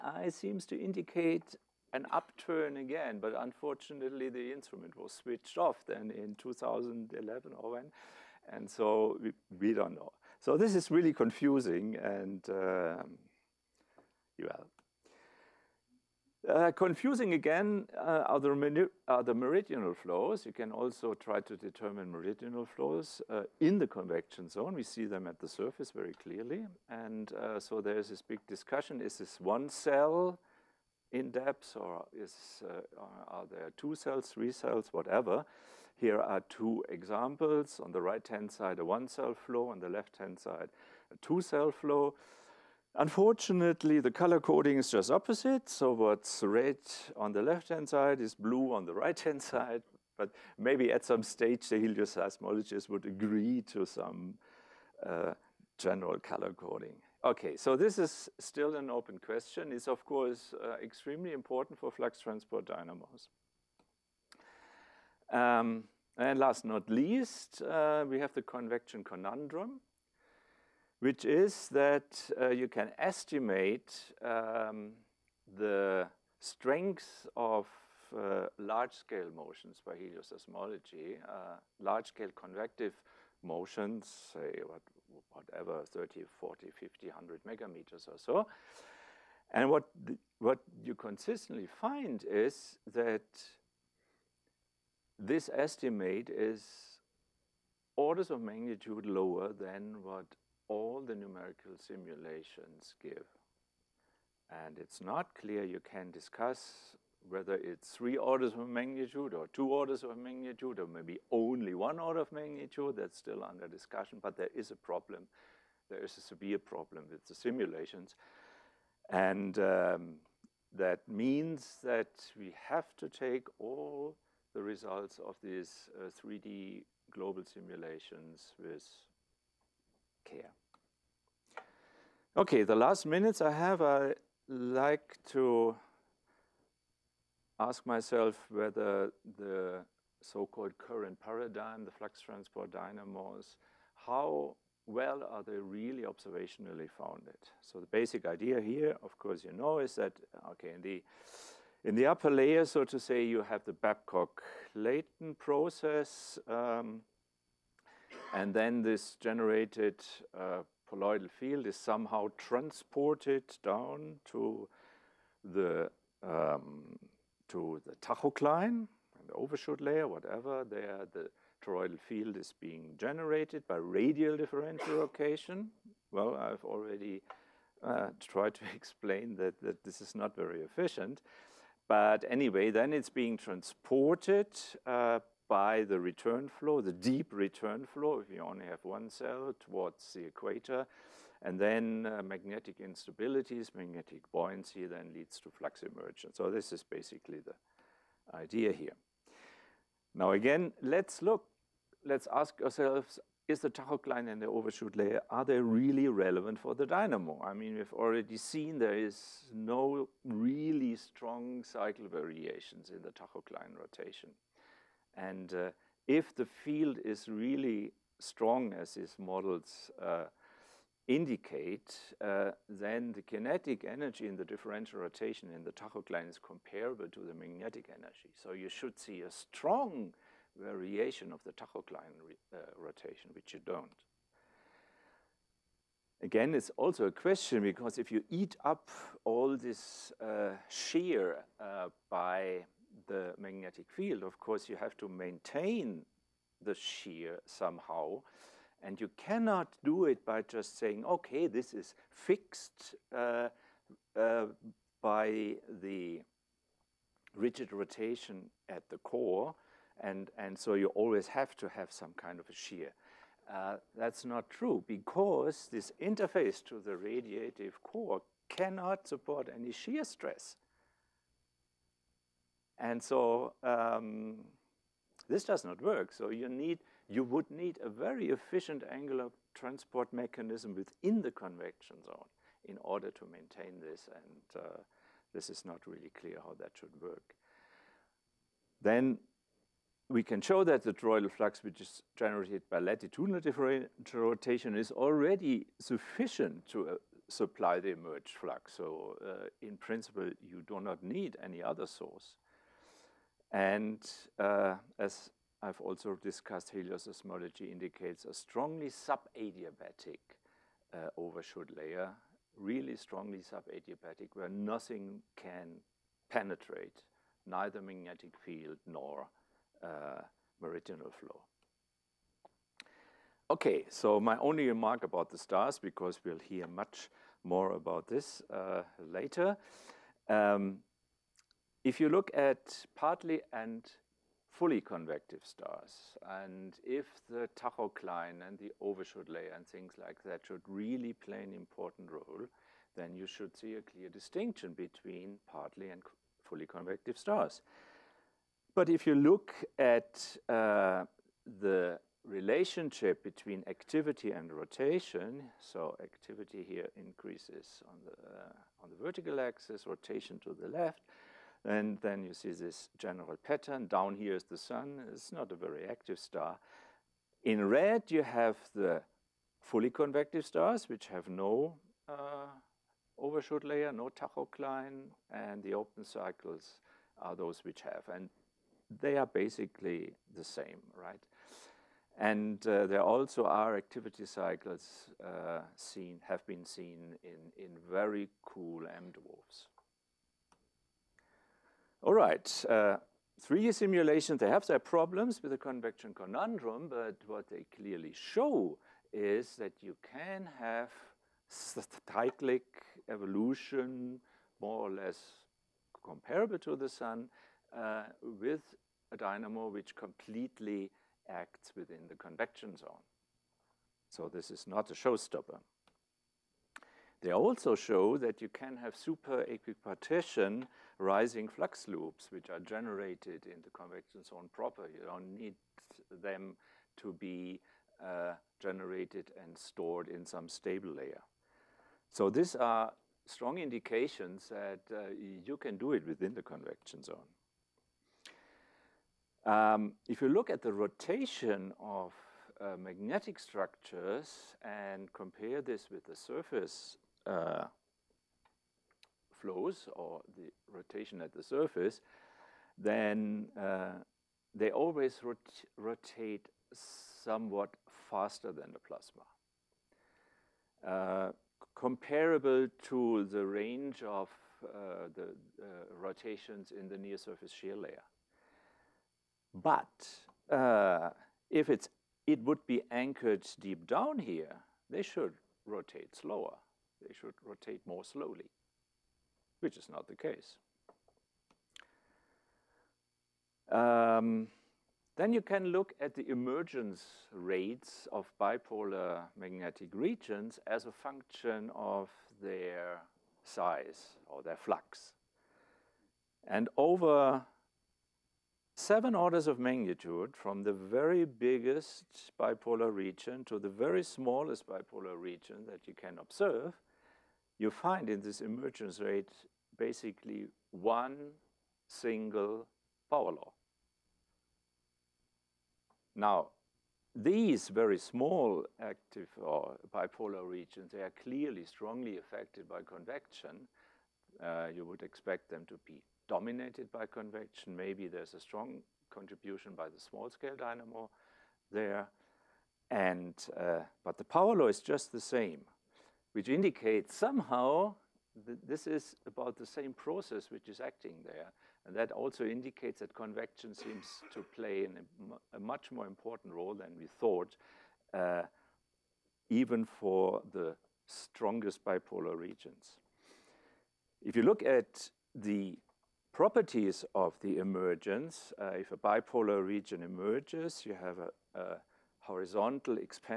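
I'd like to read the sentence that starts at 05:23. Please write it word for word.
Okay, so my only remark about the stars, because we'll hear much more about this later.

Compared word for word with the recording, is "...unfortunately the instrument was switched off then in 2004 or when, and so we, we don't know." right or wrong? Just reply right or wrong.
wrong.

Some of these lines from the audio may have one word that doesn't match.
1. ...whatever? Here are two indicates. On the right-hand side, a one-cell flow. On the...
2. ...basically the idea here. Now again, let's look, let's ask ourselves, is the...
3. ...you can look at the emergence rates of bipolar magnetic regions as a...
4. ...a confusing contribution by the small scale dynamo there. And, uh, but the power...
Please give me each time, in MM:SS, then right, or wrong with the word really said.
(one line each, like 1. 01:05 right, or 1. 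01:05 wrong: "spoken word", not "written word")
1. 00:34 wrong: "examples", not "indicates"
2. 03:16 right
3. 08:05 right
4. 08:48 wrong: "strong", not "confusing".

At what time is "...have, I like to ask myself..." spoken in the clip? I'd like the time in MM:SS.
02:13.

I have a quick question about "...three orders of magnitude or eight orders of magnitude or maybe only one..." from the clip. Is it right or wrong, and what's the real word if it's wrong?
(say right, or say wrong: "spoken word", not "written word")
wrong: "two", not "eight".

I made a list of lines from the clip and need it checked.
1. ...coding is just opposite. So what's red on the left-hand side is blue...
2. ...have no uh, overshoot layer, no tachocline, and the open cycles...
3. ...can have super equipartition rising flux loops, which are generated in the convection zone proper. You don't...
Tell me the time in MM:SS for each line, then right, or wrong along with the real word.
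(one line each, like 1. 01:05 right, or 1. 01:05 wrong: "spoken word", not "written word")
1. 00:44 right
2. 06:11 right
3. 06:58 right.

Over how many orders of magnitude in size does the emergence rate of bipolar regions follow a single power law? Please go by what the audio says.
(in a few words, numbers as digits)
7.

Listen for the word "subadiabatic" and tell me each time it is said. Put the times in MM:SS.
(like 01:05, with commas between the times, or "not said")
05:08, 05:13.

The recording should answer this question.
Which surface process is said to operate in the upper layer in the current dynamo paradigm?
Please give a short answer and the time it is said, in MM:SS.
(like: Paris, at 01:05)
Babcock-Leighton process, at 02:33.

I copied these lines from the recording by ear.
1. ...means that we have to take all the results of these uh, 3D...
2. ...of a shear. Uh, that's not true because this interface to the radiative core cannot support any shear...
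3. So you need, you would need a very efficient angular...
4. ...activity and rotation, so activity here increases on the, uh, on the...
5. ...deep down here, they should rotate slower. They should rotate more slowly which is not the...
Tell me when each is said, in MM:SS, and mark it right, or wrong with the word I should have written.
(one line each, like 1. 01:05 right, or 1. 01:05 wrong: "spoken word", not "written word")
1. 02:01 right
2. 04:22 right
3. 04:36 right
4. 05:53 right
5. 07:53 right.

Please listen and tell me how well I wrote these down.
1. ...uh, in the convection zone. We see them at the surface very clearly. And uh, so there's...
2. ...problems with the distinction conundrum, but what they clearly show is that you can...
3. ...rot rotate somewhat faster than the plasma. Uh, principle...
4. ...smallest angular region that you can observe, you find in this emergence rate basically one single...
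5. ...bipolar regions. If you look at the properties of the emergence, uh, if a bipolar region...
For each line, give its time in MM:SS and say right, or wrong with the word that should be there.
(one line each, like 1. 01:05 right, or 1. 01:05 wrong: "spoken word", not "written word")
1. 00:23 right
2. 06:34 wrong: "convection", not "distinction"
3. 07:35 wrong: "comparable", not "principle"
4. 08:24 wrong: "bipolar", not "angular"
5. 09:11 right.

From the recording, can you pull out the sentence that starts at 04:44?
And uh, this is not really clear how that should work.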